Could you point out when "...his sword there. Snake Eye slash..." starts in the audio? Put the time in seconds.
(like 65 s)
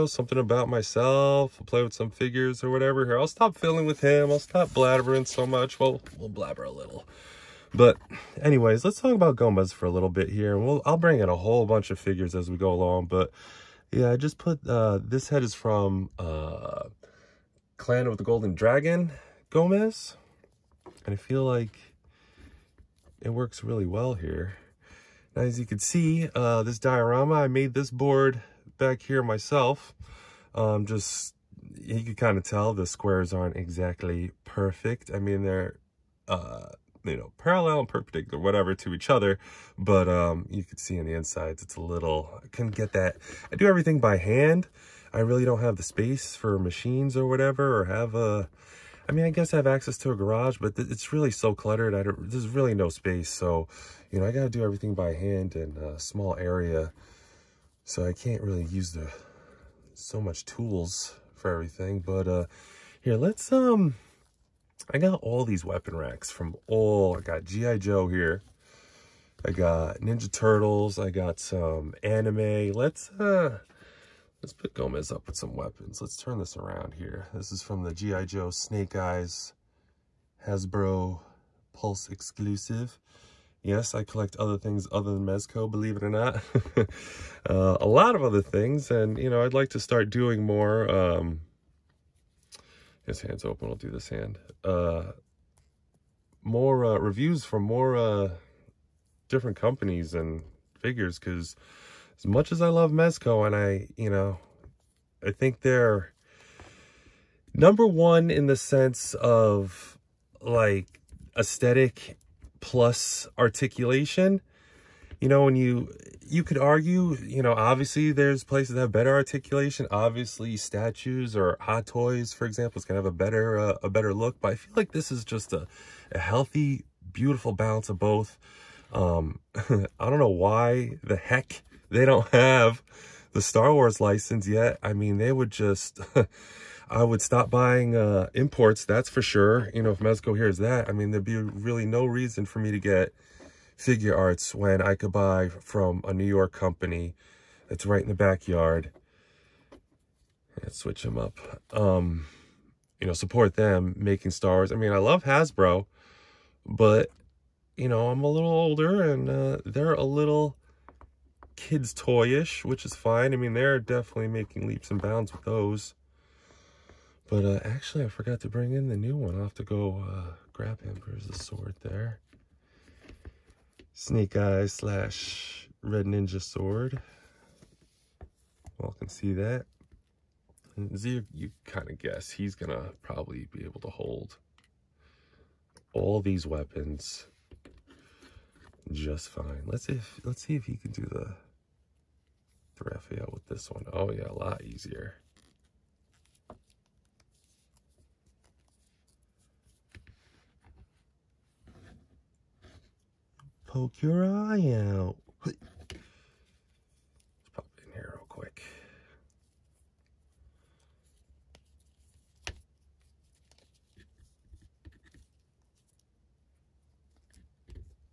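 171 s.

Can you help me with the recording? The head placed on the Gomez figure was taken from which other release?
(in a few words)
Clan of the Golden Dragon Gomez.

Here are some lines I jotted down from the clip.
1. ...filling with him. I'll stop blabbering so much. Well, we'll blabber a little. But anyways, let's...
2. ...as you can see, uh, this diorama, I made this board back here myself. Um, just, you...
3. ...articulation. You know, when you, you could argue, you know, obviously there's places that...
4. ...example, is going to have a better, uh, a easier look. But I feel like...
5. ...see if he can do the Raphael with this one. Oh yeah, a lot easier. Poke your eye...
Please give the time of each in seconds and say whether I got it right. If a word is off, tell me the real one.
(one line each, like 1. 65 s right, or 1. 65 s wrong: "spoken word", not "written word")
1. 3 s right
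2. 25 s right
3. 113 s right
4. 122 s wrong: "better", not "easier"
5. 190 s right.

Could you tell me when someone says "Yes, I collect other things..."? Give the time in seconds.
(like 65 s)
83 s.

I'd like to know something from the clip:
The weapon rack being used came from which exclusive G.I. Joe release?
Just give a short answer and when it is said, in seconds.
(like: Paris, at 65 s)
Snake Eyes Hasbro Pulse exclusive, at 78 s.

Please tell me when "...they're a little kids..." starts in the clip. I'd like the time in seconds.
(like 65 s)
159 s.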